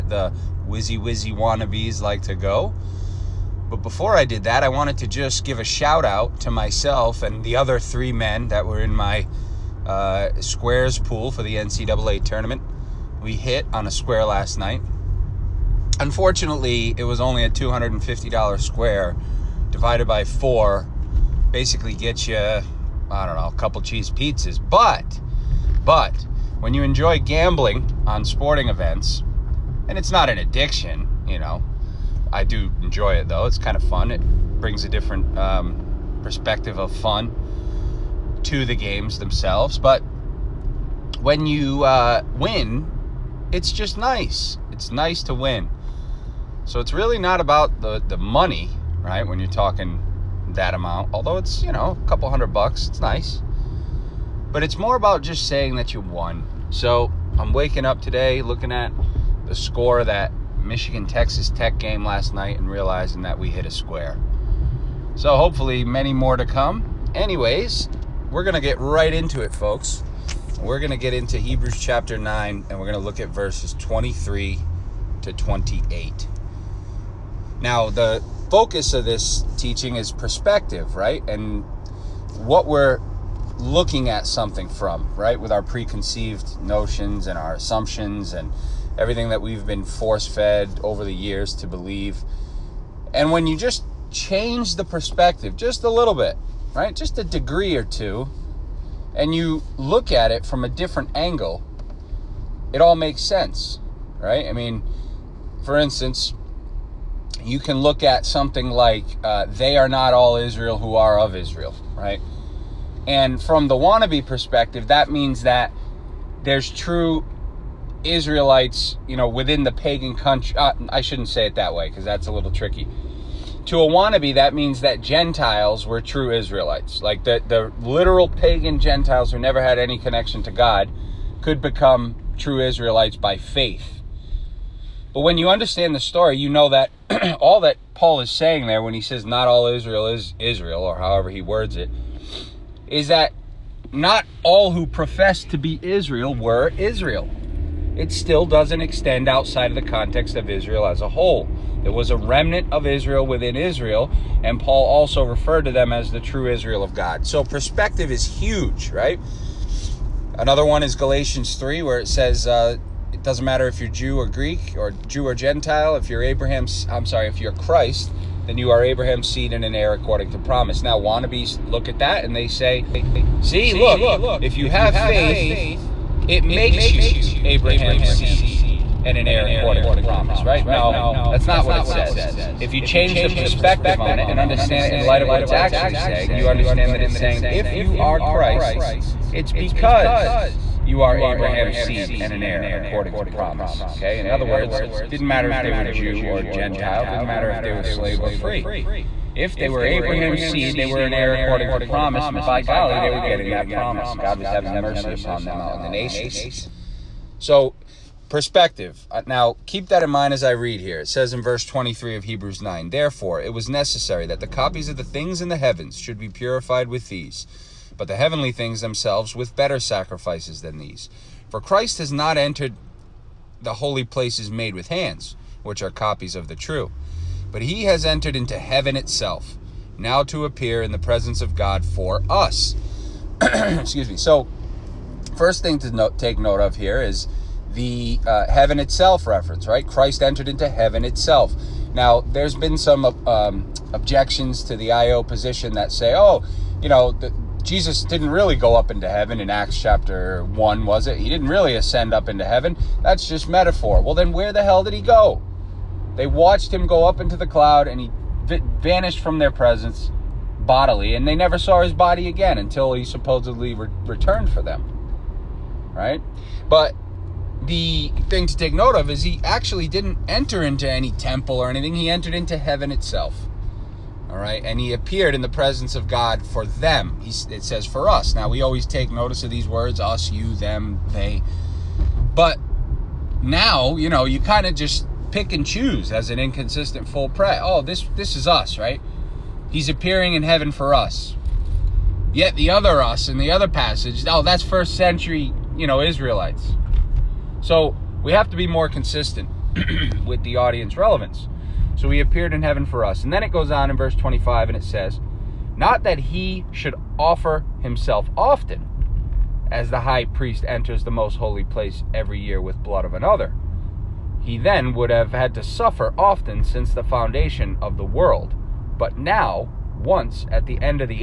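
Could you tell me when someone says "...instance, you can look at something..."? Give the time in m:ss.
1:45.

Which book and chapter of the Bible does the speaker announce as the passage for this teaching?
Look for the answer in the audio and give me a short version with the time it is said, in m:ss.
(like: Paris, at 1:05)
Hebrews 9, at 1:11.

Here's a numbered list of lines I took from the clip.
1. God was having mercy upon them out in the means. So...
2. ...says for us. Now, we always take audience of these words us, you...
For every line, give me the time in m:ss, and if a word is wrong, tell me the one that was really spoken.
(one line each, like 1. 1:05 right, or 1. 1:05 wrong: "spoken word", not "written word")
1. 3:24 wrong: "nations", not "means"
2. 4:37 wrong: "notice", not "audience".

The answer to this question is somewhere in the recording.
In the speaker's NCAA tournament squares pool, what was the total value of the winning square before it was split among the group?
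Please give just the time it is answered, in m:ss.
0:17.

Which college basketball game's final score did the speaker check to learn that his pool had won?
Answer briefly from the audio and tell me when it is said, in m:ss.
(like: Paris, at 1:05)
Michigan Texas Tech, at 1:00.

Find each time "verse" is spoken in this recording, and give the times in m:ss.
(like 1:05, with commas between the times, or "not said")
1:13, 3:31, 5:03.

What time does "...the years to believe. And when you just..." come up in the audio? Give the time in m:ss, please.
1:31.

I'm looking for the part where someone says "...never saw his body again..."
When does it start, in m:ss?
4:21.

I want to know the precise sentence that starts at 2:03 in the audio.
To a wannabe, that means that Gentiles were true Israelites.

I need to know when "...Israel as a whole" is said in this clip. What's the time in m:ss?
2:30.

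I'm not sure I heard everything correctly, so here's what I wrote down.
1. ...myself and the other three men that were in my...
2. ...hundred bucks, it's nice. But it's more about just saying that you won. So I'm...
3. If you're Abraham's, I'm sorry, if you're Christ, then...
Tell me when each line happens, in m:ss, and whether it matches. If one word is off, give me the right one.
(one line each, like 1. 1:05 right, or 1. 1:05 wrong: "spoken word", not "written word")
1. 0:06 right
2. 0:52 right
3. 2:45 right.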